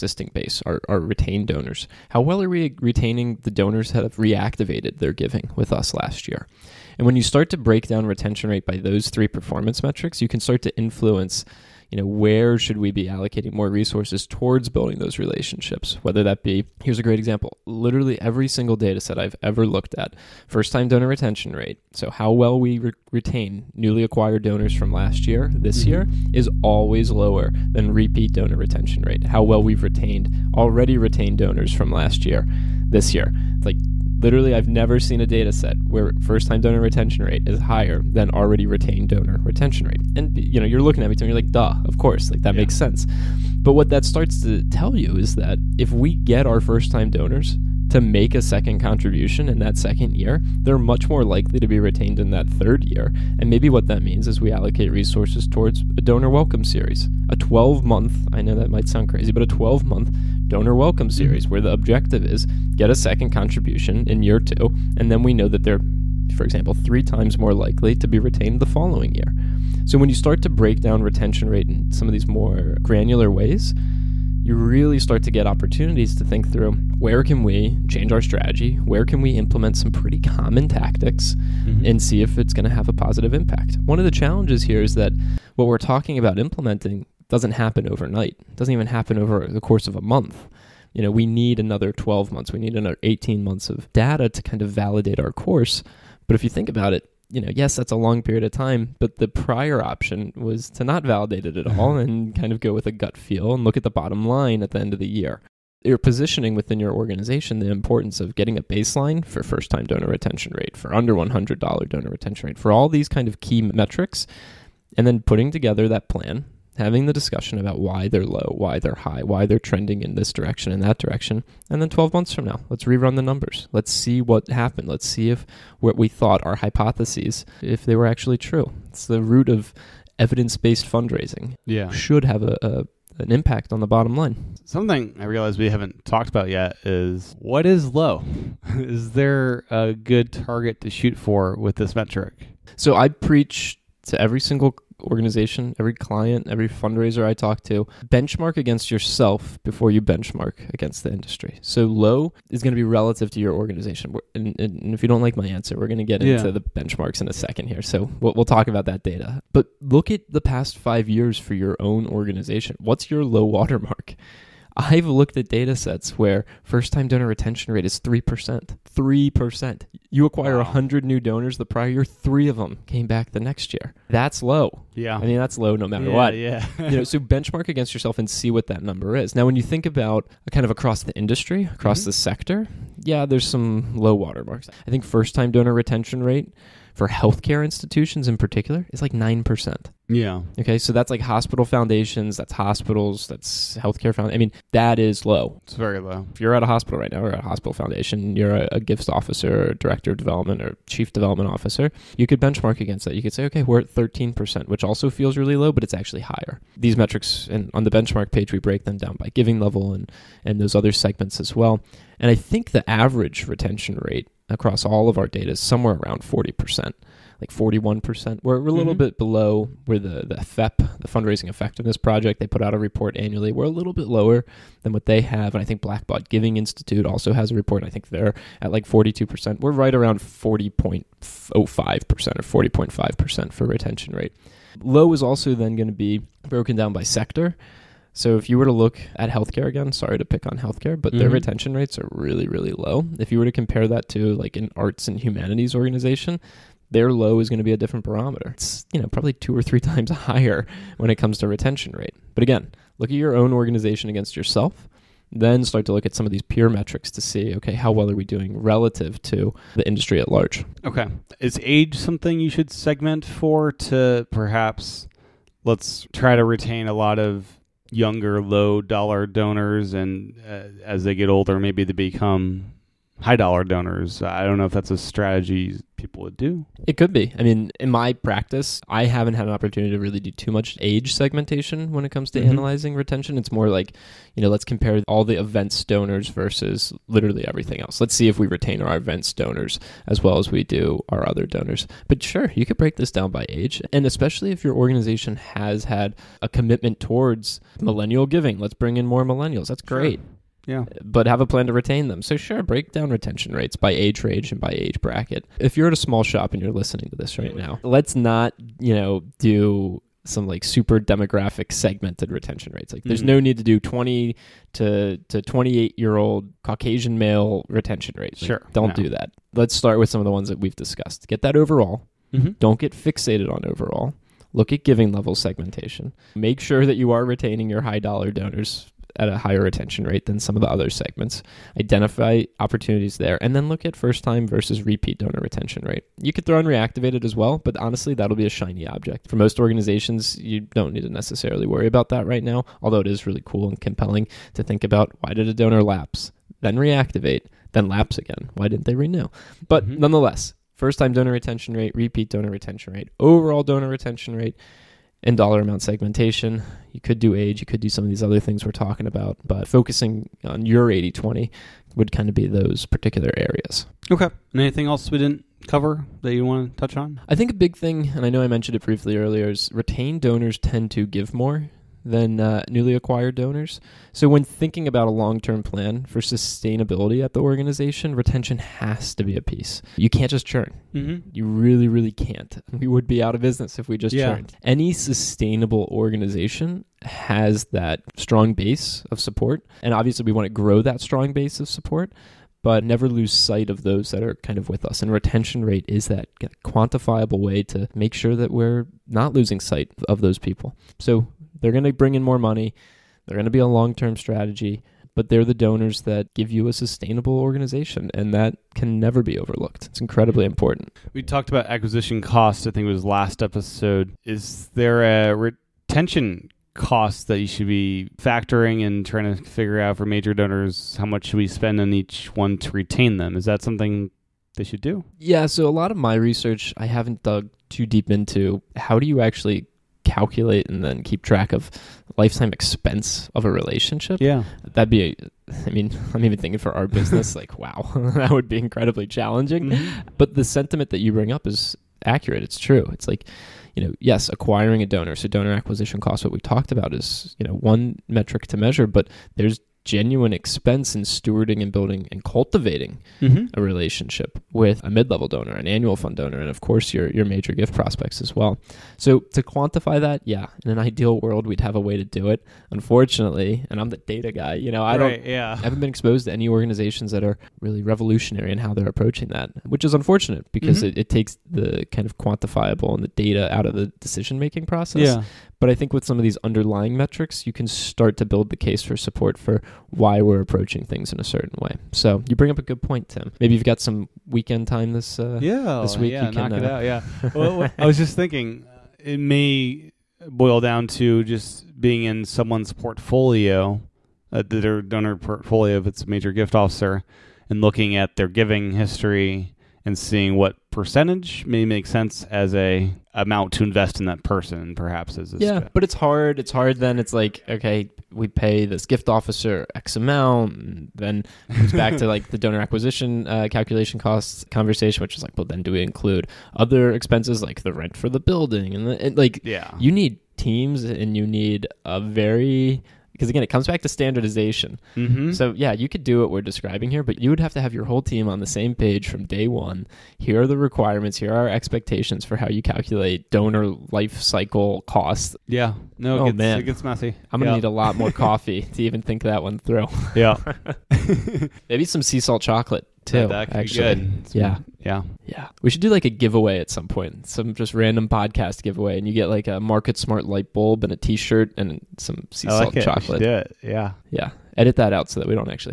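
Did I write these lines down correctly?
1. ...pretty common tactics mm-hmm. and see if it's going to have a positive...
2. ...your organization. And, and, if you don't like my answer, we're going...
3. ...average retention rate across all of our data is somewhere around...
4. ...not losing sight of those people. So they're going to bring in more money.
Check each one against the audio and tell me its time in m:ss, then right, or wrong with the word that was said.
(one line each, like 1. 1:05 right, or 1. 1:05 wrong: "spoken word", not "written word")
1. 1:19 right
2. 2:33 right
3. 3:32 right
4. 6:39 right.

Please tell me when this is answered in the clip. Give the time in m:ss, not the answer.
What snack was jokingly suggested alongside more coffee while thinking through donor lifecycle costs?
9:02.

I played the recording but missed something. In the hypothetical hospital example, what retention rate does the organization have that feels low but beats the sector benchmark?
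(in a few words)
13%.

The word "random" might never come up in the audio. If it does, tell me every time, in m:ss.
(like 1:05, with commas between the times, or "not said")
9:07.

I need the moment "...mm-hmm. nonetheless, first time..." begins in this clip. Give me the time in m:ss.
5:49.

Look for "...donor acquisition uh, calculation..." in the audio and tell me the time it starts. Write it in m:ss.
8:32.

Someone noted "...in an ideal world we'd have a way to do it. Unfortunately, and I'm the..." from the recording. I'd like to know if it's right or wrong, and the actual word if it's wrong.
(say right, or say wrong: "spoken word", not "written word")
right.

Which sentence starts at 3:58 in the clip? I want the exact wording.
So if you were to look at healthcare again, sorry to pick on healthcare, but mm-hmm.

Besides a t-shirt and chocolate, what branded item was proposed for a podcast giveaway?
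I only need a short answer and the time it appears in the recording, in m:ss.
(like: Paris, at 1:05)
MarketSmart light bulb, at 9:09.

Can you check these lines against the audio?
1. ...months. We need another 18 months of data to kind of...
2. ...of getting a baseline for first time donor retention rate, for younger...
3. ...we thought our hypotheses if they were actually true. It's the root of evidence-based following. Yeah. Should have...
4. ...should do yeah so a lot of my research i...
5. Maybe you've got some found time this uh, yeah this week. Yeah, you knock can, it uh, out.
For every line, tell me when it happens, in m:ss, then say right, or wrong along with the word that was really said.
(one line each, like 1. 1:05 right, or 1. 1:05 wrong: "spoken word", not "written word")
1. 1:32 right
2. 1:48 wrong: "under", not "younger"
3. 2:05 wrong: "fundraising", not "following"
4. 7:04 right
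5. 8:03 wrong: "weekend", not "found".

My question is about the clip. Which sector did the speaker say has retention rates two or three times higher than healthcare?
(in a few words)
arts and humanities.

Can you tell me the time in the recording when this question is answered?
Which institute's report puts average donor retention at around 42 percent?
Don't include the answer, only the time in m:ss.
3:45.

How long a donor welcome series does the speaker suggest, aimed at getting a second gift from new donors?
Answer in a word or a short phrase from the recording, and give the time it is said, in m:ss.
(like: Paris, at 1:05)
12 month, at 0:59.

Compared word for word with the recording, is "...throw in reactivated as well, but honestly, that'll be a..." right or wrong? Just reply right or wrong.
right.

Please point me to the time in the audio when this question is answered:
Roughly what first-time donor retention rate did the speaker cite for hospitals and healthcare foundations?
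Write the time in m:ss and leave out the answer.
3:09.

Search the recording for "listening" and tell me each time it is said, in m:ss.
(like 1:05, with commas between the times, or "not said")
5:06.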